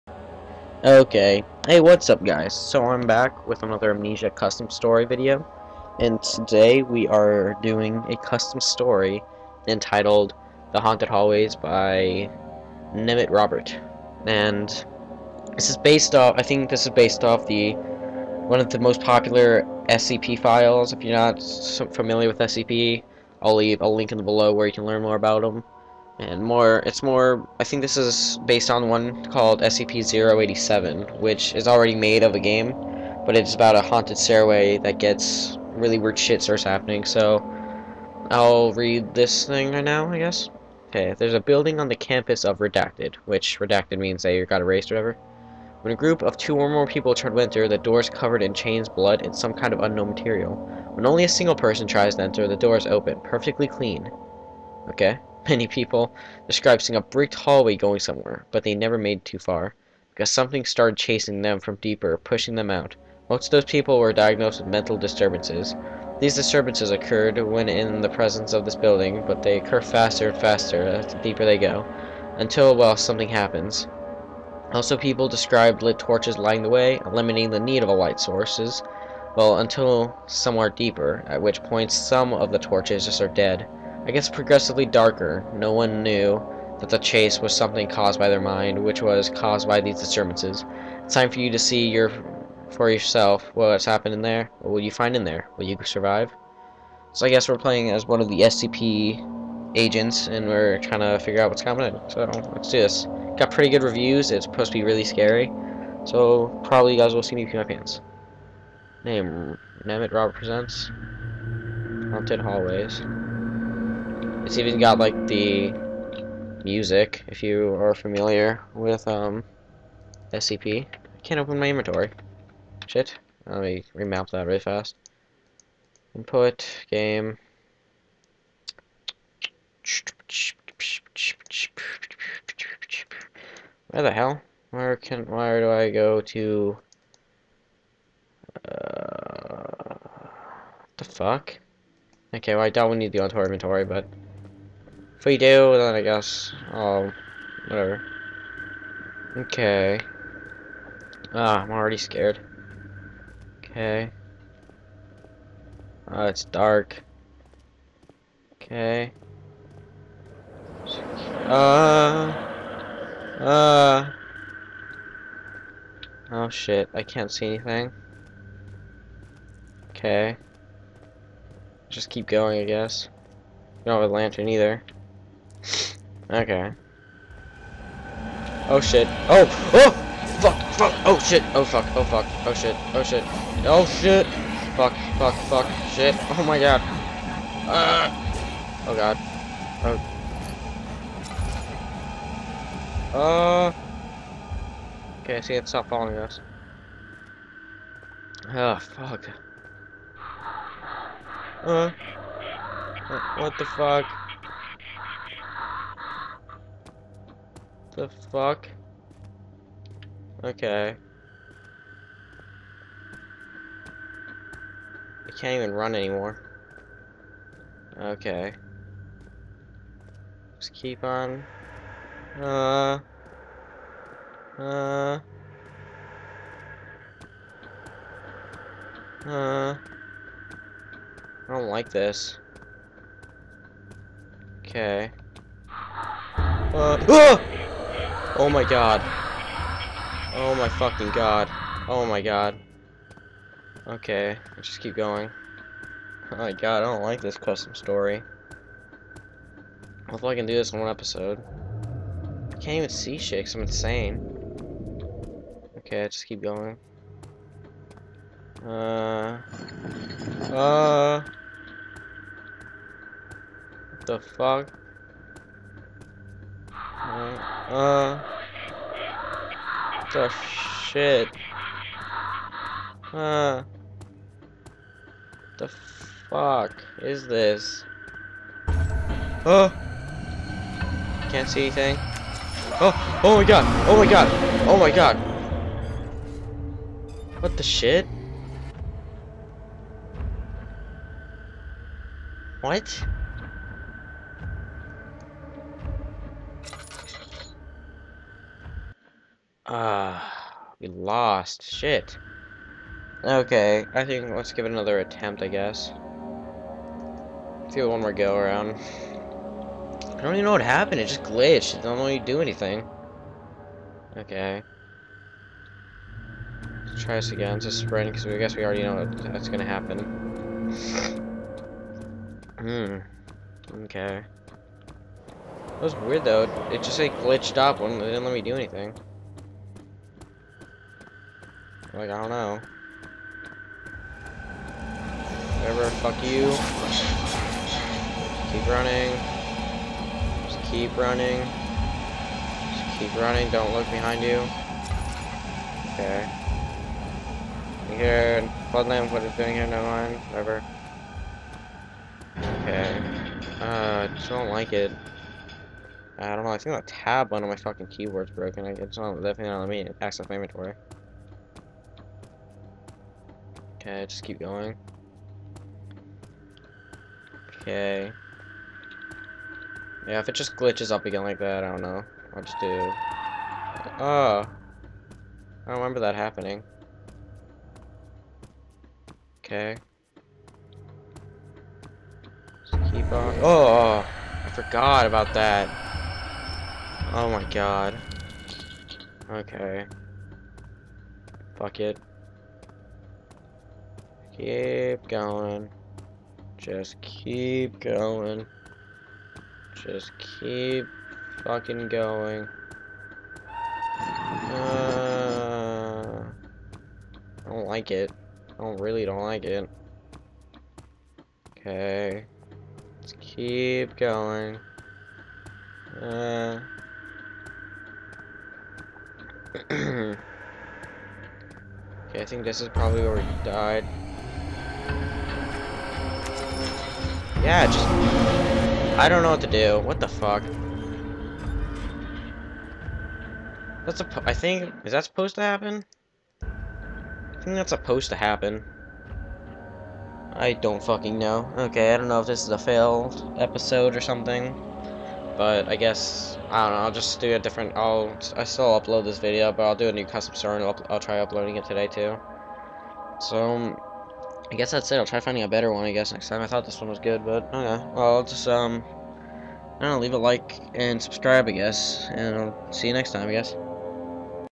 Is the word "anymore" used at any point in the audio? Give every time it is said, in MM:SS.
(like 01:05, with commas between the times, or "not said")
03:35.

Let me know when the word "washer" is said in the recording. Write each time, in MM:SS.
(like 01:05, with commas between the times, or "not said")
not said.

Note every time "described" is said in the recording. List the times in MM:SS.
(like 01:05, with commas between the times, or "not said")
00:56, 01:15.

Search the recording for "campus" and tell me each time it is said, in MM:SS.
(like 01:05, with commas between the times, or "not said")
00:41.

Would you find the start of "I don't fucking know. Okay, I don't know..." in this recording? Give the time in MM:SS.
07:20.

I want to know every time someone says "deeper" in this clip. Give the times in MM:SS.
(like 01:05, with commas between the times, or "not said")
01:01, 01:11, 01:20.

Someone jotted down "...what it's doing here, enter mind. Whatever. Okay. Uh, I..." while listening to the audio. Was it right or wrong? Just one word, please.
wrong.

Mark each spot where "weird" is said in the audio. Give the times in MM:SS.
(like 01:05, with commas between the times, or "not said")
00:35, 05:25.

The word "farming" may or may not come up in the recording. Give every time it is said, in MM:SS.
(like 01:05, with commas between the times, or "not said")
not said.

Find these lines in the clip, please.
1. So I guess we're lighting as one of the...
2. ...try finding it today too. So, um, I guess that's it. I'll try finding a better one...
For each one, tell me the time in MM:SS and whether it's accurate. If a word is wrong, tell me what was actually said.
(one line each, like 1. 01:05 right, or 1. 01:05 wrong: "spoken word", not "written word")
1. 01:37 wrong: "playing", not "lighting"
2. 07:30 wrong: "uploading", not "finding".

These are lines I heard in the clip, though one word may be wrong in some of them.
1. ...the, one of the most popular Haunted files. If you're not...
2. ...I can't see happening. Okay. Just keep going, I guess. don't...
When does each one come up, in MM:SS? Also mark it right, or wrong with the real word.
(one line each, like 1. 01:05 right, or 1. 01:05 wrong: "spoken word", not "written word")
1. 00:17 wrong: "SCP", not "Haunted"
2. 02:46 wrong: "anything", not "happening".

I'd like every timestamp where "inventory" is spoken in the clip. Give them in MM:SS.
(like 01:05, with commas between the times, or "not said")
02:01, 02:23, 06:00.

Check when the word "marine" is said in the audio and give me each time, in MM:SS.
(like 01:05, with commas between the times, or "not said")
not said.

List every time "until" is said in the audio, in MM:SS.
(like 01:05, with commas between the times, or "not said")
01:12, 01:19.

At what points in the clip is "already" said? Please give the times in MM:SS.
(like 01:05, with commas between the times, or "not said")
00:31, 02:31, 05:18.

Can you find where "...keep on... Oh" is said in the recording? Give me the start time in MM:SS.
06:22.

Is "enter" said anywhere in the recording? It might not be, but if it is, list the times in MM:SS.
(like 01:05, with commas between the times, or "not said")
00:47, 00:52.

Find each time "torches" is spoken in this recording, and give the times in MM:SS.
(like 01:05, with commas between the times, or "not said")
01:15, 01:22.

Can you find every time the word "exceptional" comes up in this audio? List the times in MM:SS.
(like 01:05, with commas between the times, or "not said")
not said.